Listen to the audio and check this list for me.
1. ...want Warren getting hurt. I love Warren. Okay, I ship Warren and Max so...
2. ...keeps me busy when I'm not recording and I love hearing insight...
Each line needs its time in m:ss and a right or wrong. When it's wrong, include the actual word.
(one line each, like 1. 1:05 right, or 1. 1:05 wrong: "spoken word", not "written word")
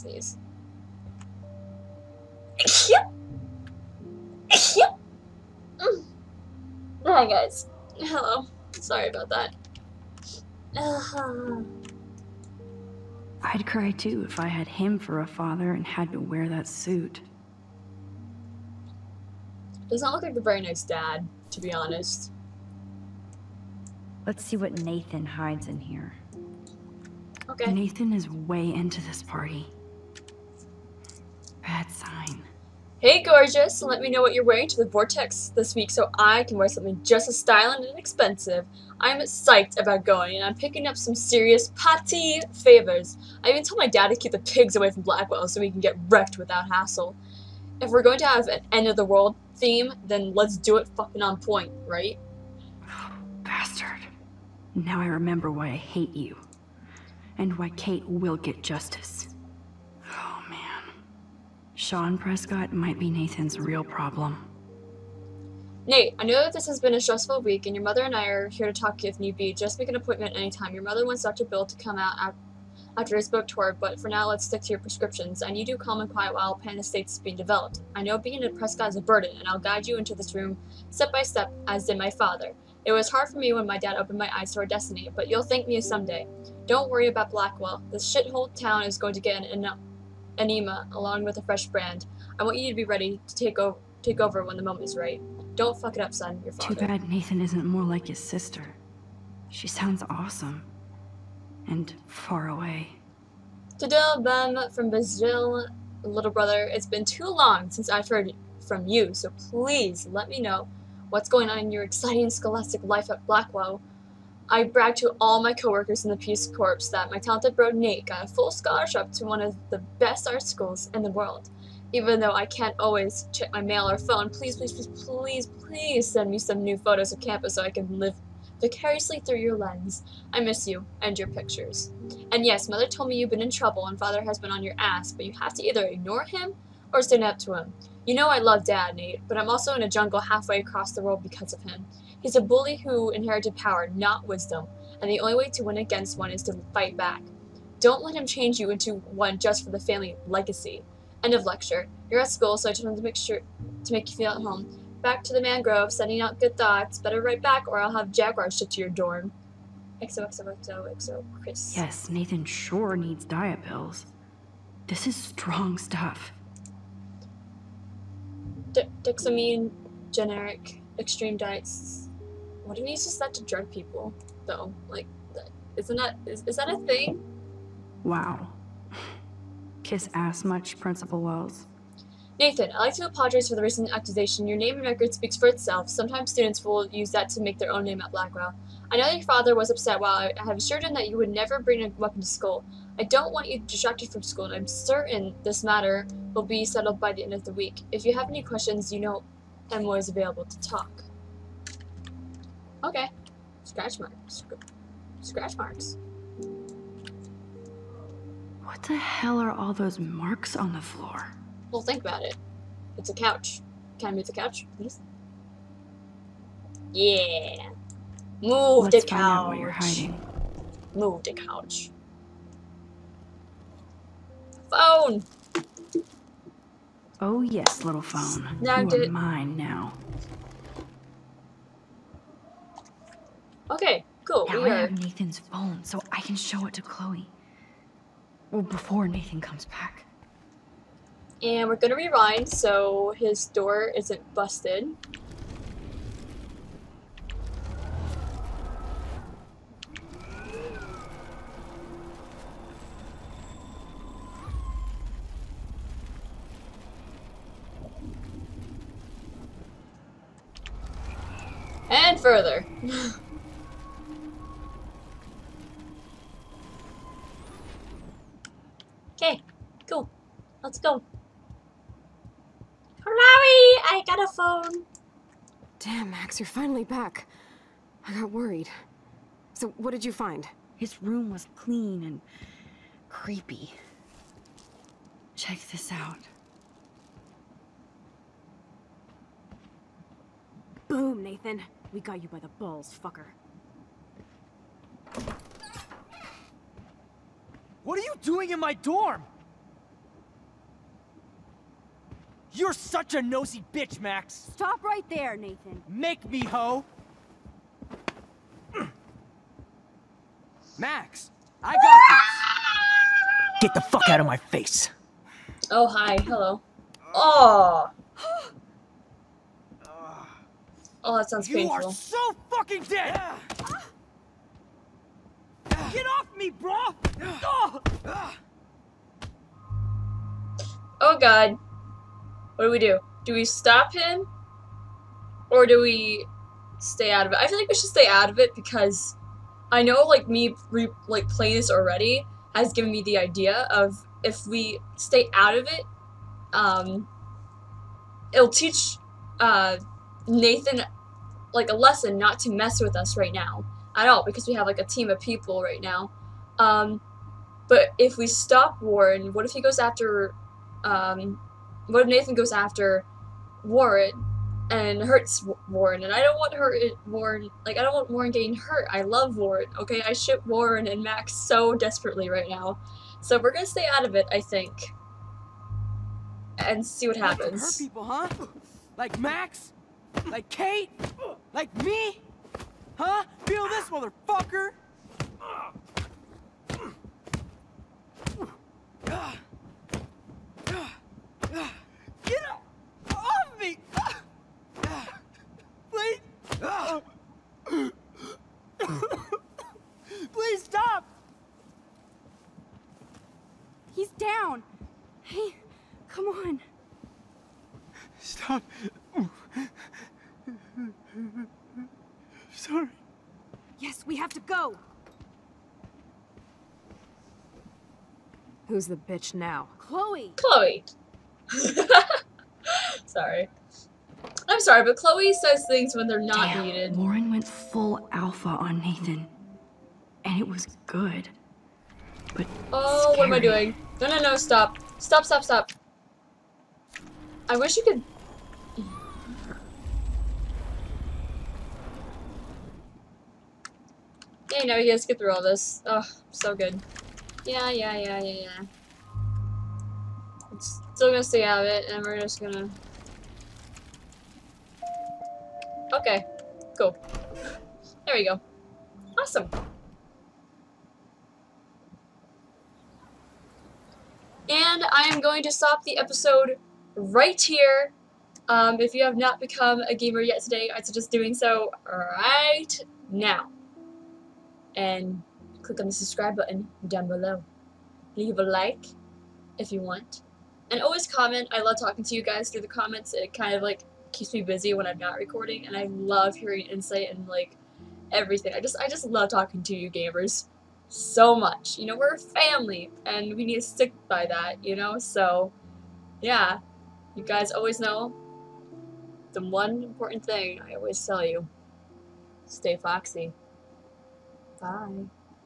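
1. 6:07 right
2. 8:04 right.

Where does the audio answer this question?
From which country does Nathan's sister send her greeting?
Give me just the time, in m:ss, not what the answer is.
1:44.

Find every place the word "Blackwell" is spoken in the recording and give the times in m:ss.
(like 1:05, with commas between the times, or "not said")
0:45, 1:27, 1:53, 3:08.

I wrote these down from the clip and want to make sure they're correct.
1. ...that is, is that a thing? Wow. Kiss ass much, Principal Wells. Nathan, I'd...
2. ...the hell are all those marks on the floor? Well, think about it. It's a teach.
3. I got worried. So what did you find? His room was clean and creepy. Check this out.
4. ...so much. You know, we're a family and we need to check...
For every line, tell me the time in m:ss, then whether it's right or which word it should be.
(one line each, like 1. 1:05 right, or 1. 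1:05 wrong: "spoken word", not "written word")
1. 2:55 right
2. 3:28 wrong: "couch", not "teach"
3. 4:38 right
4. 8:10 wrong: "stick", not "check".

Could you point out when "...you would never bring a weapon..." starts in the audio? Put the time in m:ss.
3:11.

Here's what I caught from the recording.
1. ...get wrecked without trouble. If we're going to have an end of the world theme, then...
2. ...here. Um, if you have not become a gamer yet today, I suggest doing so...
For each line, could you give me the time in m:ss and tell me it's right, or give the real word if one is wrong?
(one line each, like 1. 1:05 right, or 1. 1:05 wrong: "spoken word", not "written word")
1. 0:45 wrong: "hassle", not "trouble"
2. 7:47 right.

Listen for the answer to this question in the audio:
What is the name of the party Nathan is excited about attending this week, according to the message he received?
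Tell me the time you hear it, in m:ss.
0:34.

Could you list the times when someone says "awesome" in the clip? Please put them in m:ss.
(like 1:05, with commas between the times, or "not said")
1:40, 7:39.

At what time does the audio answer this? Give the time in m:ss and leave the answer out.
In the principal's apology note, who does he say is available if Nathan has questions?
3:19.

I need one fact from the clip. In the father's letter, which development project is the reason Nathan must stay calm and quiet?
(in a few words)
Pan Estates.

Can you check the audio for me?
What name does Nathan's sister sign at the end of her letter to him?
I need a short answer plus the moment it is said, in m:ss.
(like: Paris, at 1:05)
Chris, at 2:41.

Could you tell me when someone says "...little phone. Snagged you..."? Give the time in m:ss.
3:47.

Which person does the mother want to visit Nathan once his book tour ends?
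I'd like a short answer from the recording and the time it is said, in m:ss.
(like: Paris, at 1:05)
Dr. Bill, at 1:11.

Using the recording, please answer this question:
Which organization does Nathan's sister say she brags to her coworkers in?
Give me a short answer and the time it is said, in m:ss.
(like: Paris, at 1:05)
Peace Corps, at 1:56.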